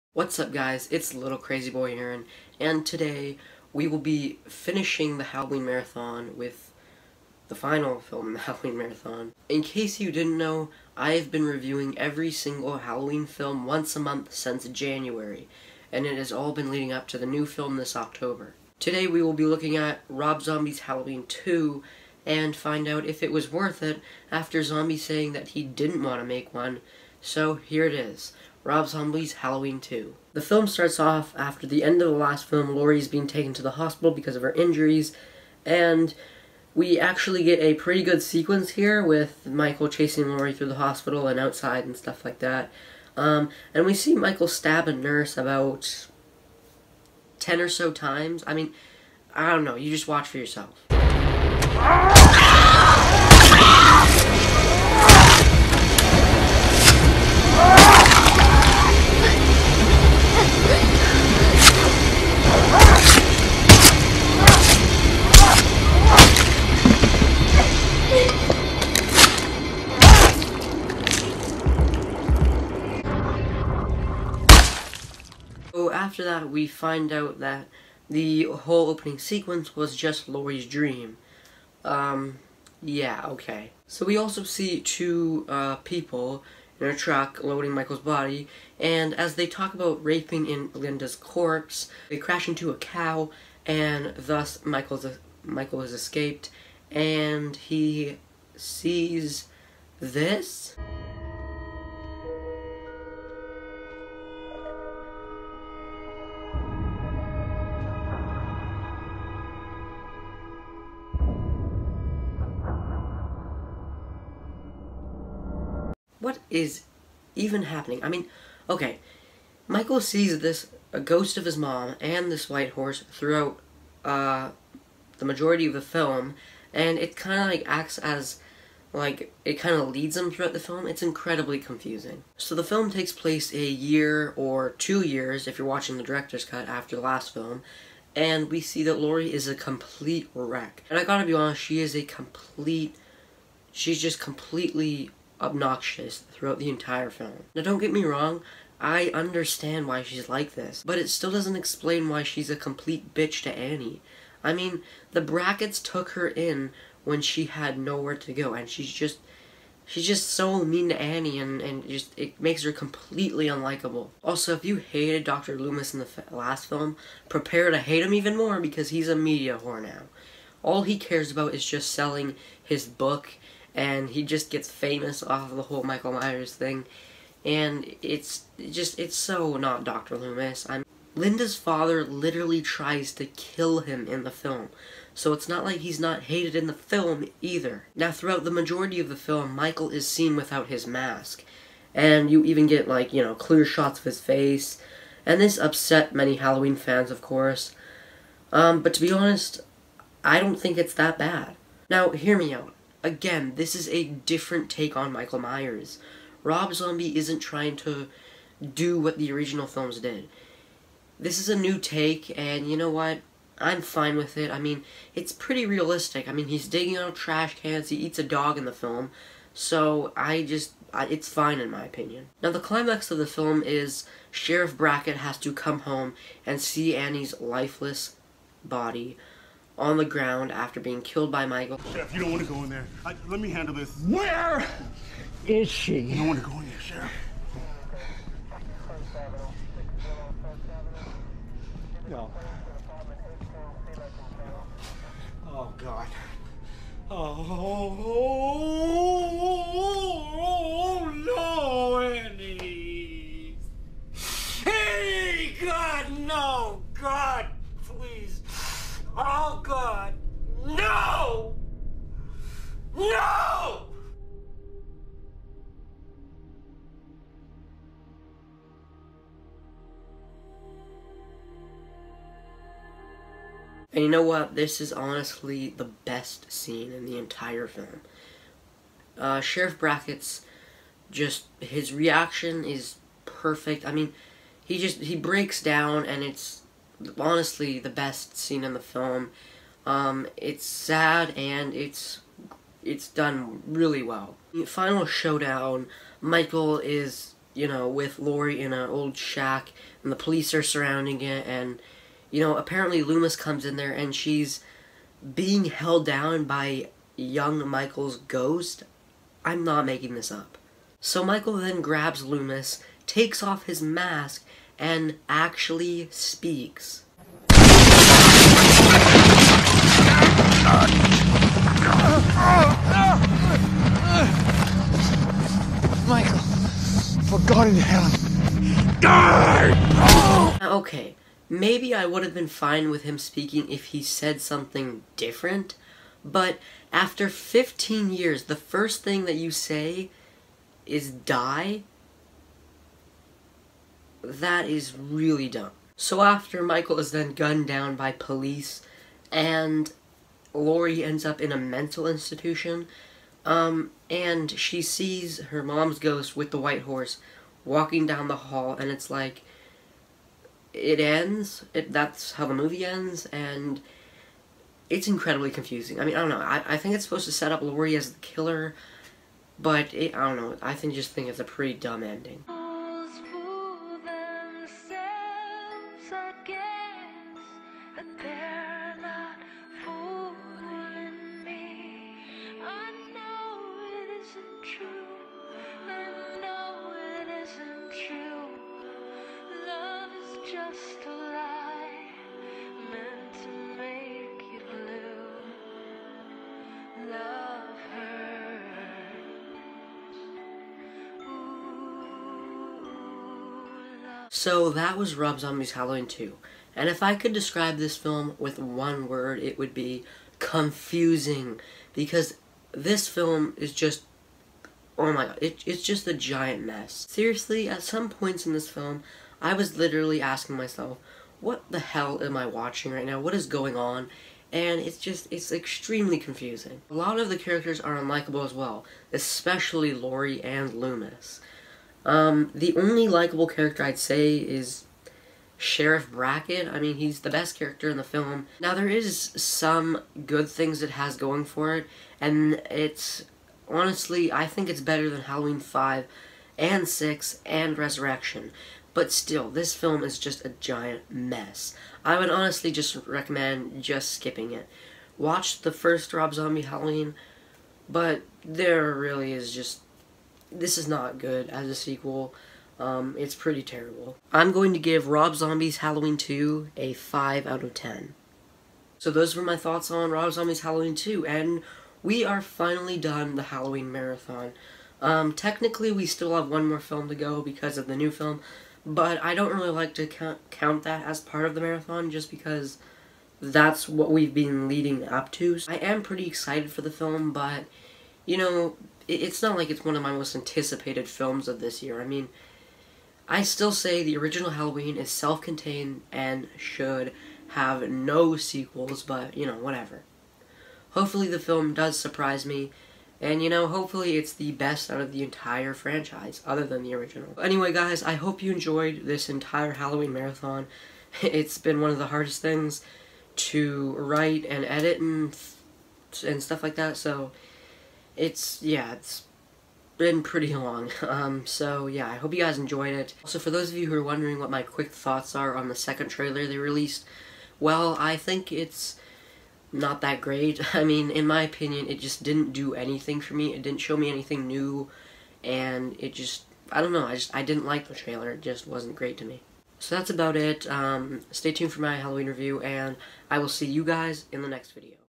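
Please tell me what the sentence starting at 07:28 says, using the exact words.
But still, this film is just a giant mess.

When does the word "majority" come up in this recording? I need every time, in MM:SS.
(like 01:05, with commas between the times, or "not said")
02:05, 03:08.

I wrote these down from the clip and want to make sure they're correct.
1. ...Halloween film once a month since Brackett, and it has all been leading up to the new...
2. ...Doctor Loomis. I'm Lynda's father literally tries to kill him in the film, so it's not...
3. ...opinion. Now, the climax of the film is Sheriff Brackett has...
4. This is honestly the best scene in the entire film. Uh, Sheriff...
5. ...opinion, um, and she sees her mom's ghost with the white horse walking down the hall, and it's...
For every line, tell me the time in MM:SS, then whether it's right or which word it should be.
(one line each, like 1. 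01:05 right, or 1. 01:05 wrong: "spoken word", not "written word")
1. 00:12 wrong: "January", not "Brackett"
2. 02:59 right
3. 03:41 right
4. 04:34 right
5. 05:52 wrong: "institution", not "opinion".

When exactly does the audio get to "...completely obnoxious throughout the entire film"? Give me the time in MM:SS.
02:24.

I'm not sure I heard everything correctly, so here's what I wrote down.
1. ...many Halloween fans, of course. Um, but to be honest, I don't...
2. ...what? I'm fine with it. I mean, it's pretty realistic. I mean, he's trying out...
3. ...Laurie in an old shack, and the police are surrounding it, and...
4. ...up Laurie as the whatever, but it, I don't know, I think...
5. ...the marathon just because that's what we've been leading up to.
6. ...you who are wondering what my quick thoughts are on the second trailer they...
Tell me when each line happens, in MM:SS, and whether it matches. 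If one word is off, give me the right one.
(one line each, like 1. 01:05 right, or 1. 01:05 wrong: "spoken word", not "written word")
1. 03:16 right
2. 03:32 wrong: "digging", not "trying"
3. 04:58 right
4. 06:07 wrong: "killer", not "whatever"
5. 08:01 right
6. 08:43 right.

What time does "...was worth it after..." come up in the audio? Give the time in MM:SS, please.
00:23.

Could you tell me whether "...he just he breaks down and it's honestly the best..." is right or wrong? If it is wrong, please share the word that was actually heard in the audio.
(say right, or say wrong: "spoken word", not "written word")
right.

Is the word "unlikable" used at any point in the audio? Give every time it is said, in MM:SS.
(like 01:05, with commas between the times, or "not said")
02:43, 07:07.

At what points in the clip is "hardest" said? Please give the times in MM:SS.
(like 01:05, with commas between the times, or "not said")
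08:32.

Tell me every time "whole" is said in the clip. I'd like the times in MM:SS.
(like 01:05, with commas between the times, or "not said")
01:18, 02:55.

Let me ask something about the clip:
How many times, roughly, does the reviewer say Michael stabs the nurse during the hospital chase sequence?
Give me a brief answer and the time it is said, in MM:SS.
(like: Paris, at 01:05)
10, at 00:45.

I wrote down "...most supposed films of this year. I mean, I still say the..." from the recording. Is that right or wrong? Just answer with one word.
wrong.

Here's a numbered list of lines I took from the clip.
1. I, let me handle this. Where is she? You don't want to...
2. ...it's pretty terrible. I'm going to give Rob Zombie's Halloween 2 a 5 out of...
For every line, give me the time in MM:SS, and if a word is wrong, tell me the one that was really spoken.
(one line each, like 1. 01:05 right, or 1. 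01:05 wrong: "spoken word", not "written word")
1. 03:53 right
2. 07:43 right.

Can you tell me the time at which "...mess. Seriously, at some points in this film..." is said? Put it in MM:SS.
06:56.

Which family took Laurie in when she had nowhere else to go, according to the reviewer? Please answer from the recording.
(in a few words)
The Bracketts.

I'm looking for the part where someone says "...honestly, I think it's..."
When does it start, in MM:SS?
07:23.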